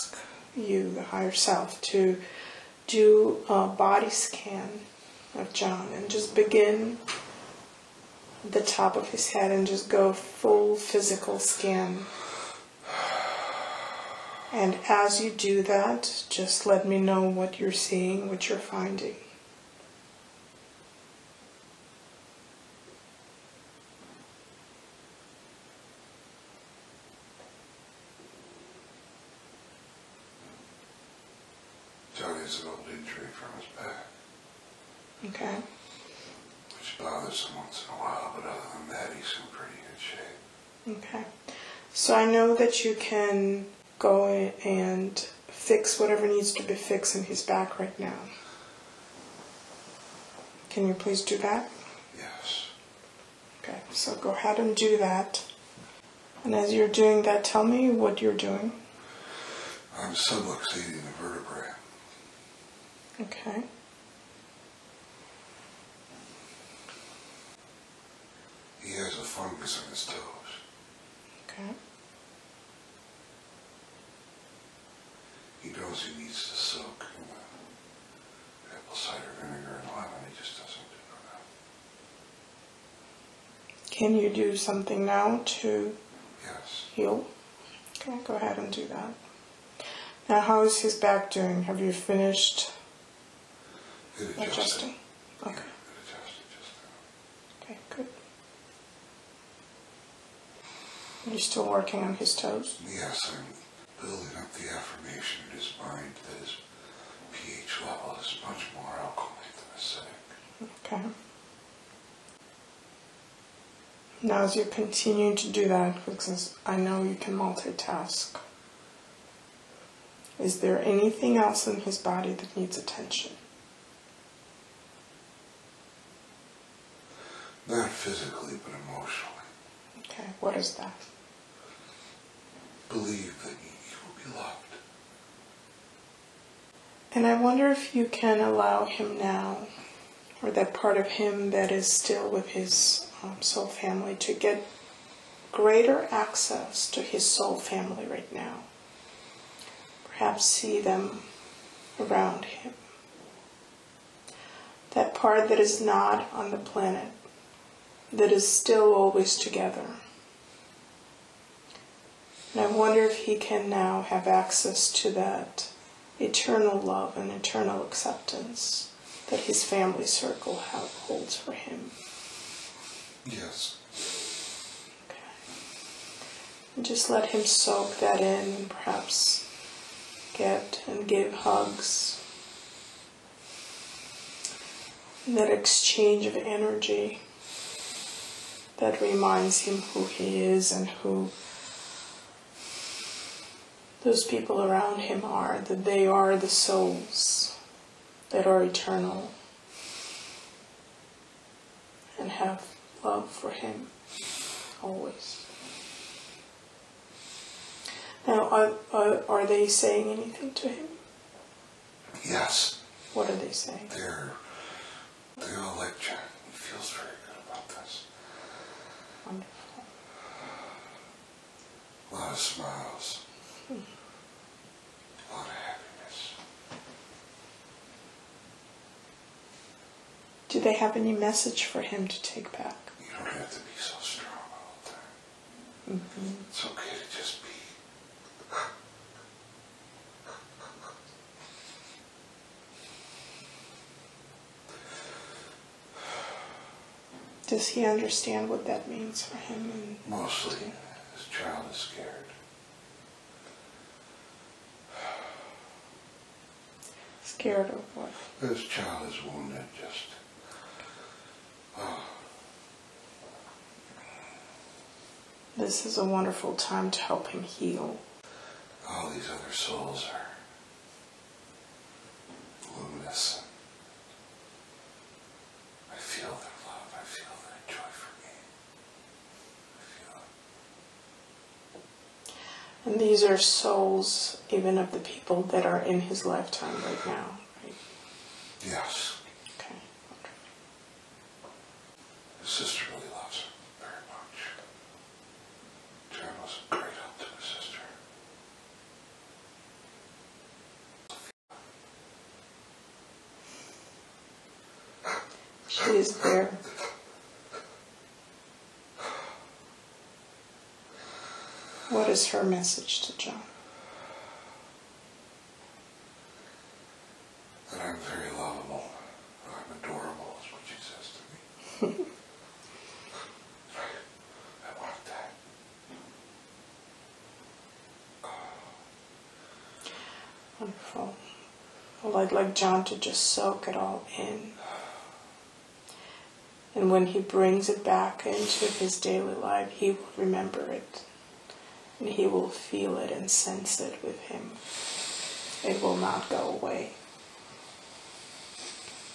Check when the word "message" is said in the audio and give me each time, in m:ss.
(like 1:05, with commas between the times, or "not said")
3:51, 5:12.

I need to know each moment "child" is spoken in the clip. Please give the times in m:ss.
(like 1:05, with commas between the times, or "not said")
4:11, 4:18.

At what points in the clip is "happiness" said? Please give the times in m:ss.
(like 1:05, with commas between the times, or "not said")
3:45.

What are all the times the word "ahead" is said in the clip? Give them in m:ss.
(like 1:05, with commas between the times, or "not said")
0:54, 1:28.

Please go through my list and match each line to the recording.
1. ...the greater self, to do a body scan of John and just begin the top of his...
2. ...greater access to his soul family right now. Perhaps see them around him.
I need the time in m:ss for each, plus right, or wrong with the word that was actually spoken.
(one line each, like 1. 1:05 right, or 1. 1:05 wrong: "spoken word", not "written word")
1. 0:00 wrong: "higher", not "greater"
2. 2:25 right.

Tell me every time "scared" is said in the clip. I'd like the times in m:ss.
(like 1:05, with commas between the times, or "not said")
4:11, 4:17.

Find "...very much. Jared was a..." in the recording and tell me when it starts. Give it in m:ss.
4:53.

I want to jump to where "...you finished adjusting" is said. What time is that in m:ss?
1:31.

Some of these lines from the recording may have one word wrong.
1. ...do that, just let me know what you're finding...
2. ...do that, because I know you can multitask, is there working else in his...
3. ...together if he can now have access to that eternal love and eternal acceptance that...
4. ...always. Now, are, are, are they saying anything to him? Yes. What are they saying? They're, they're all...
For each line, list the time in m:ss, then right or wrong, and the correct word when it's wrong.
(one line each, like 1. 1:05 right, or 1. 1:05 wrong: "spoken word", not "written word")
1. 0:15 wrong: "seeing", not "finding"
2. 1:55 wrong: "anything", not "working"
3. 2:42 wrong: "wonder", not "together"
4. 3:24 right.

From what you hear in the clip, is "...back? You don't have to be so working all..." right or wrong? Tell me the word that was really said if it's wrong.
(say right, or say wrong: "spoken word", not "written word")
wrong: "strong", not "working".